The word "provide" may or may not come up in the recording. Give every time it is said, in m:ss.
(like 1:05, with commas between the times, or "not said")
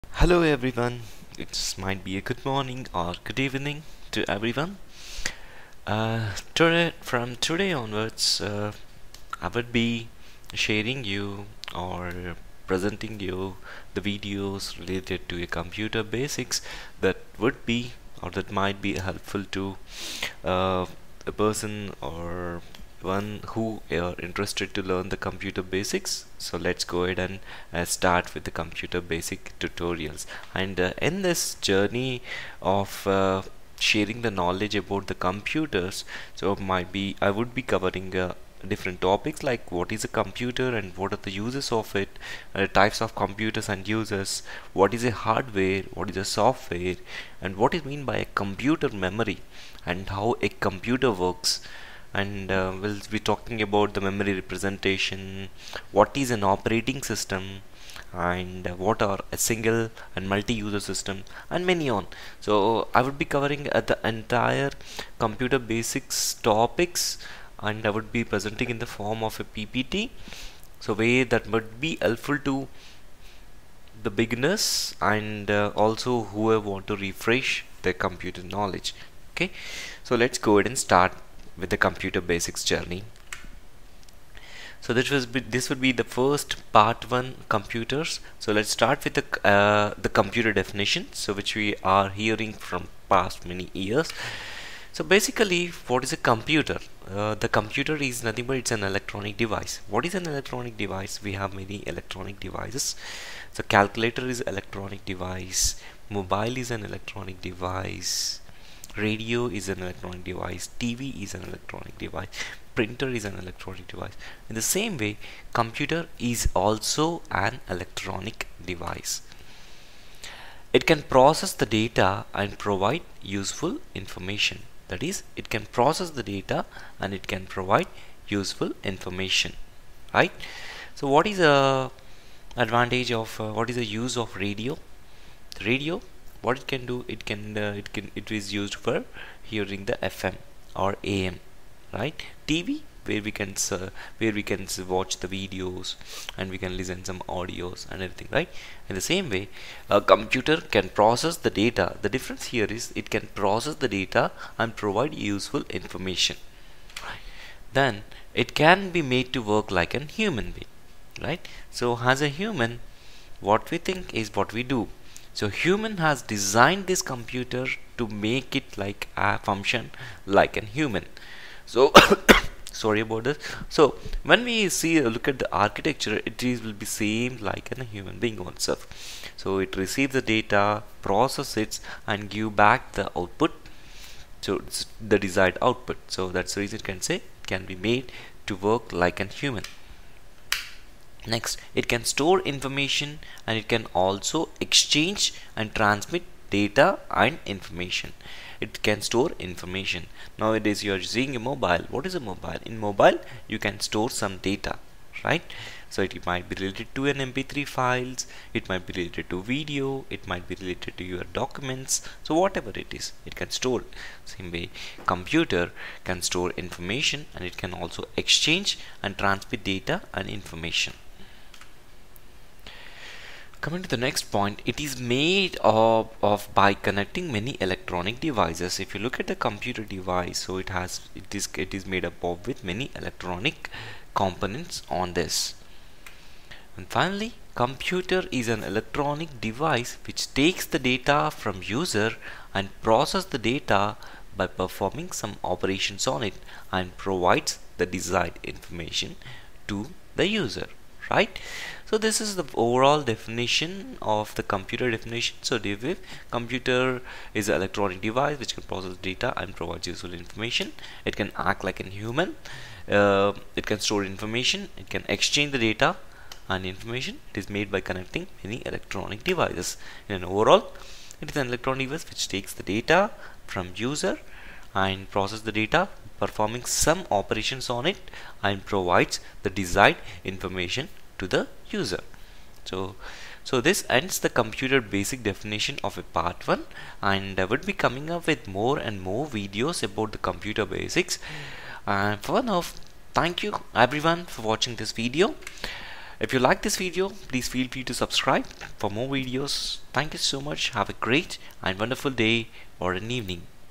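2:02, 2:07, 2:34, 4:06, 4:19, 4:38.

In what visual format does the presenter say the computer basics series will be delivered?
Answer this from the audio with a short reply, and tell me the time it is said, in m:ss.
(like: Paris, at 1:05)
PPT, at 1:09.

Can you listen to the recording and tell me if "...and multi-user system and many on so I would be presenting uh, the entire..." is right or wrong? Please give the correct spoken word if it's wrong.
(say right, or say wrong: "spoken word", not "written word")
wrong: "covering", not "presenting".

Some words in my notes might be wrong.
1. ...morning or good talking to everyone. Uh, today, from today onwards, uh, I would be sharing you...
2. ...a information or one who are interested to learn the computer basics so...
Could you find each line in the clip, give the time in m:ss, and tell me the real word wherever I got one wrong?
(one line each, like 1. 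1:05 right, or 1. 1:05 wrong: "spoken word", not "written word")
1. 0:02 wrong: "evening", not "talking"
2. 0:21 wrong: "person", not "information".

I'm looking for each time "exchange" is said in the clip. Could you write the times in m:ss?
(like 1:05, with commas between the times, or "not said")
3:14, 3:38, 4:25.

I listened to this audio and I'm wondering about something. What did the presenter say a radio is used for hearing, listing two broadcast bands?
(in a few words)
FM or AM.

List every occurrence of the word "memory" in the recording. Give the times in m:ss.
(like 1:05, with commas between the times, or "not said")
0:48, 0:54.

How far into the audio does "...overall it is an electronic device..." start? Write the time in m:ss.
4:30.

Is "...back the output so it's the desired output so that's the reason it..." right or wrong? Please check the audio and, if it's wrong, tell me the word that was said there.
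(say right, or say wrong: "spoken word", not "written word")
right.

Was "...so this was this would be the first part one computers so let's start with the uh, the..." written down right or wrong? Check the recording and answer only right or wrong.
right.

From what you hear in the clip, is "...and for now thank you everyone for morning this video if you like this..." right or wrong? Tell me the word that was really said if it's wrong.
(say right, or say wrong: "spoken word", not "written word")
wrong: "watching", not "morning".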